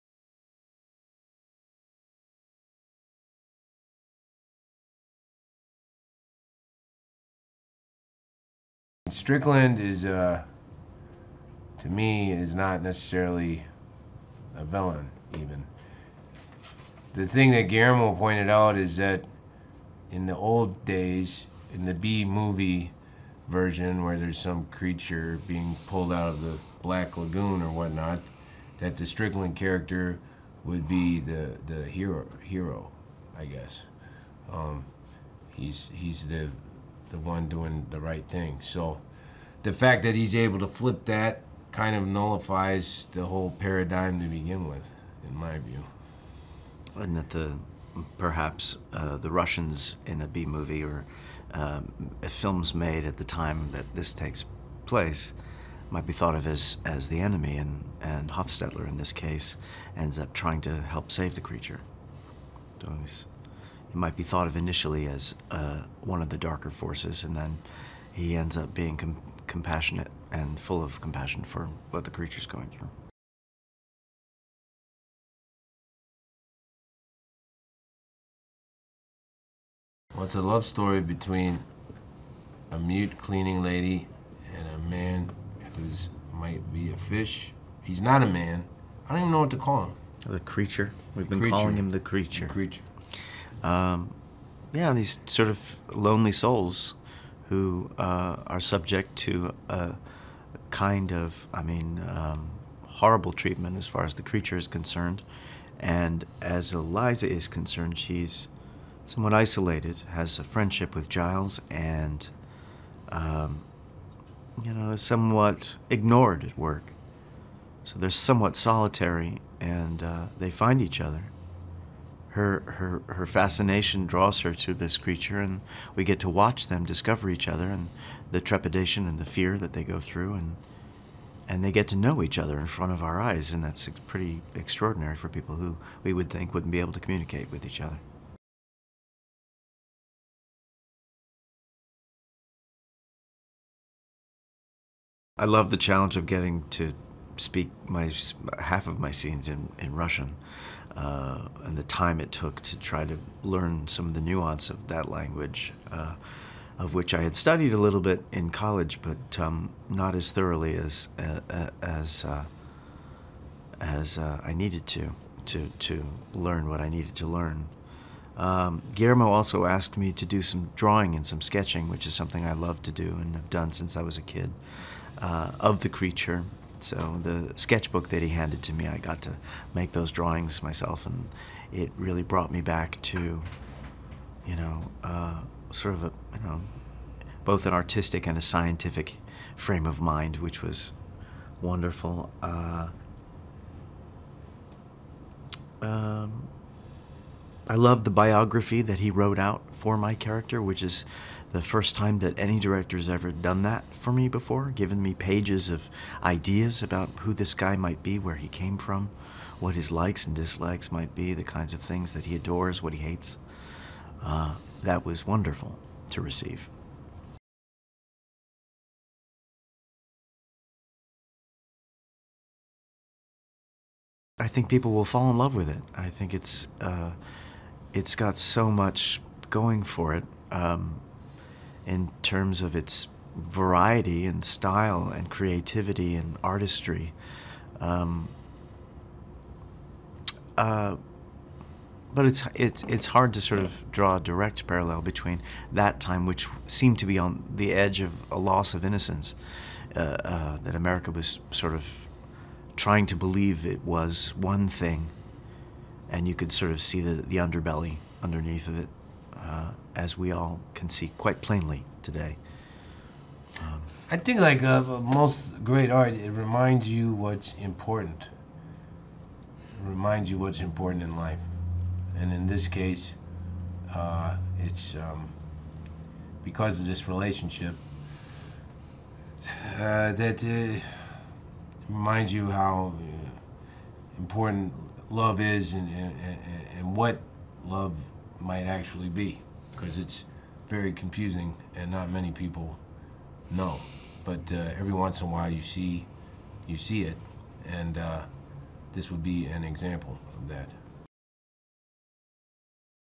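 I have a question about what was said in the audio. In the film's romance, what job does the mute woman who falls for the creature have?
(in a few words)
cleaning lady.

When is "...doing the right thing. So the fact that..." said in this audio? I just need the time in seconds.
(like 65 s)
37 s.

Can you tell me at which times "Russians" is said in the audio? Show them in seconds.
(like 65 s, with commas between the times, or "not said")
49 s, 149 s.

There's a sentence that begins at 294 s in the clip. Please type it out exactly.
But uh, every once in a while you see, you see it, and uh, this would be an example of that.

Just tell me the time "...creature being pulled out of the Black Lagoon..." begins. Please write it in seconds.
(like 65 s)
24 s.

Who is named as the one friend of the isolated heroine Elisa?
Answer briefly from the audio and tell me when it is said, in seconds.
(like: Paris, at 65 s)
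Giles, at 111 s.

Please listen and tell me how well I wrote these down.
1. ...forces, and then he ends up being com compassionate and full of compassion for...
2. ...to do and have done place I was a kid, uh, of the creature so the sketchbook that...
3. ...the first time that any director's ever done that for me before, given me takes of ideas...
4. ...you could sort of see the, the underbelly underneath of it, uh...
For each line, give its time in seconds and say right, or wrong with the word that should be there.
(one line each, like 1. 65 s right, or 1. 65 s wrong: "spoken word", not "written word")
1. 66 s right
2. 172 s wrong: "since", not "place"
3. 201 s wrong: "pages", not "takes"
4. 256 s right.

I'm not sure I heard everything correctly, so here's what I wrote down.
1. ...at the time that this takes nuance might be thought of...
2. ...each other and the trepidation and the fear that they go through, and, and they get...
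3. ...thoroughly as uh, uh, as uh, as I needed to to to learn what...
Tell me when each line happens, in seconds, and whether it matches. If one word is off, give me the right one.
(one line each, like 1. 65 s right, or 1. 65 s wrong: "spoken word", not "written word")
1. 53 s wrong: "place", not "nuance"
2. 127 s right
3. 160 s right.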